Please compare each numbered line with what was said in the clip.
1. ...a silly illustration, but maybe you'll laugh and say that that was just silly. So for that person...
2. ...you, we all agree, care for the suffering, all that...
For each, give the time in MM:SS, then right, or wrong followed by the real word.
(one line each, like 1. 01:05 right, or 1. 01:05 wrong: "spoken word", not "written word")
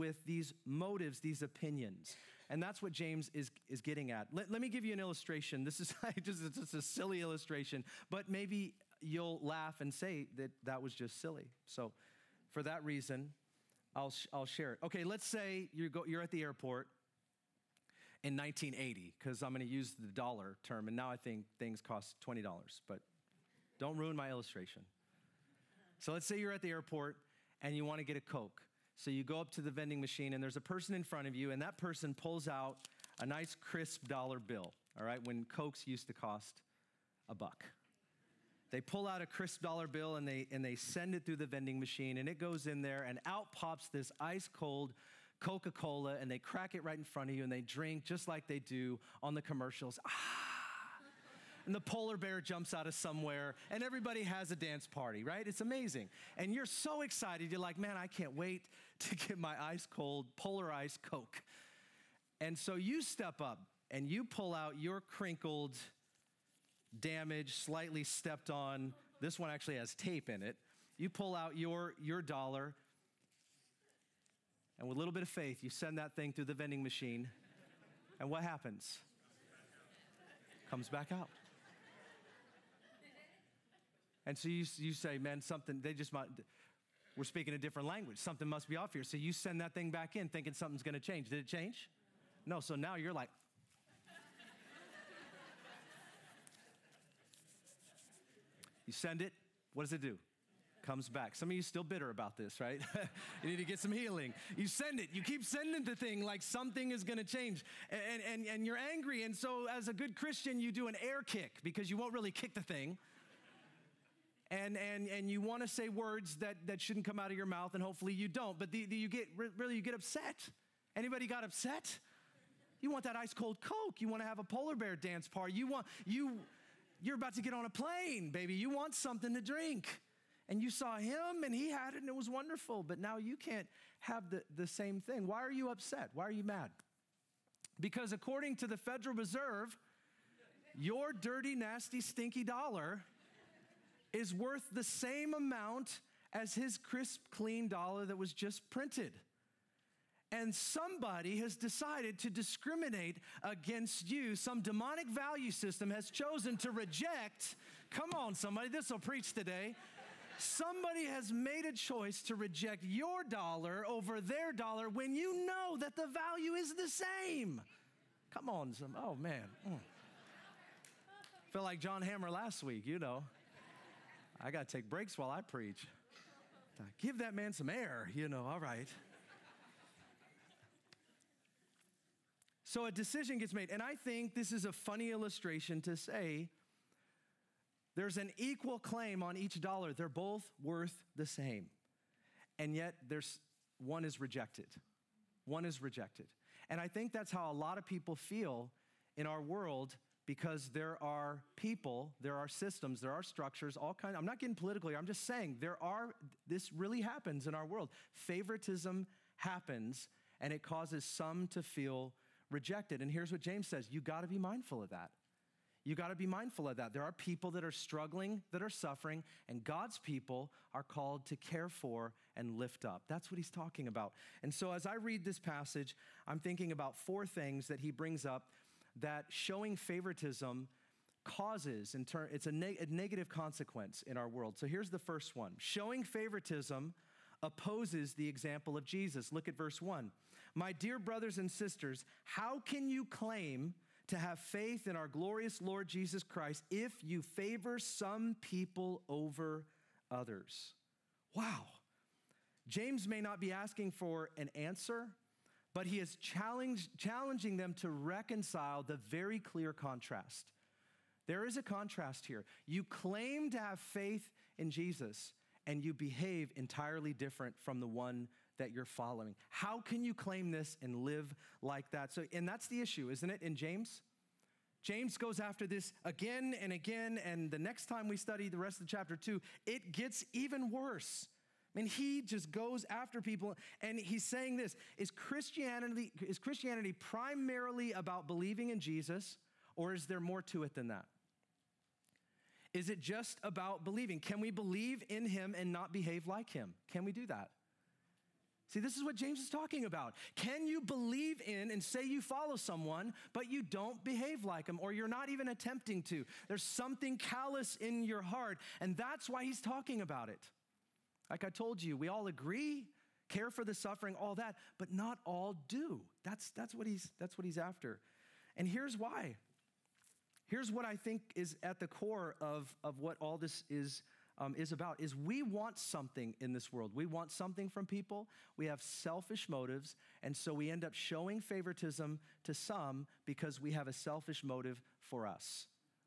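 1. 00:06 wrong: "reason", not "person"
2. 05:11 right.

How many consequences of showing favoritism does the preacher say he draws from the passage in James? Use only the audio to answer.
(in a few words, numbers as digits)
4.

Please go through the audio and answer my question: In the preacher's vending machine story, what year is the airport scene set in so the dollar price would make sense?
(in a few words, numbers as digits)
1980.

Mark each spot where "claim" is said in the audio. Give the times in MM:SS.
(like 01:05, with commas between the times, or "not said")
03:08, 04:03, 04:22, 04:30.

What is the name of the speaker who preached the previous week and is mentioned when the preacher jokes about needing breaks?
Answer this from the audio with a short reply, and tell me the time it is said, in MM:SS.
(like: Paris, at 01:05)
John Hammer, at 02:51.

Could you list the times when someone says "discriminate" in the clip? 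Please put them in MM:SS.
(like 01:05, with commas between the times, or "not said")
02:32.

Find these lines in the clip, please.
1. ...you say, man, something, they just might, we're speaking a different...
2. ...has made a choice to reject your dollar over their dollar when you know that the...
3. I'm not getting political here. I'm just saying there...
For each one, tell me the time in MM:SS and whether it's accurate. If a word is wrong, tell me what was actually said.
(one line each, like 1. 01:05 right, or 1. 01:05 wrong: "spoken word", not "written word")
1. 01:24 right
2. 02:41 right
3. 03:24 right.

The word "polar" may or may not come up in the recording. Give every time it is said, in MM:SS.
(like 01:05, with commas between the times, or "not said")
00:51, 01:00, 02:04.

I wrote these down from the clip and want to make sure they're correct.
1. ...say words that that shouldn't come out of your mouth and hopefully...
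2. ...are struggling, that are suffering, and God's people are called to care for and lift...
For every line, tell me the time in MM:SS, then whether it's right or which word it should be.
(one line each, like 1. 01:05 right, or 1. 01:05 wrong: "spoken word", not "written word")
1. 01:55 right
2. 03:37 right.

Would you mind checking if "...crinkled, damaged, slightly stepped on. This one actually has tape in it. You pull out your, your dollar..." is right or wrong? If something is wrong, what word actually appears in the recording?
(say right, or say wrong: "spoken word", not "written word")
right.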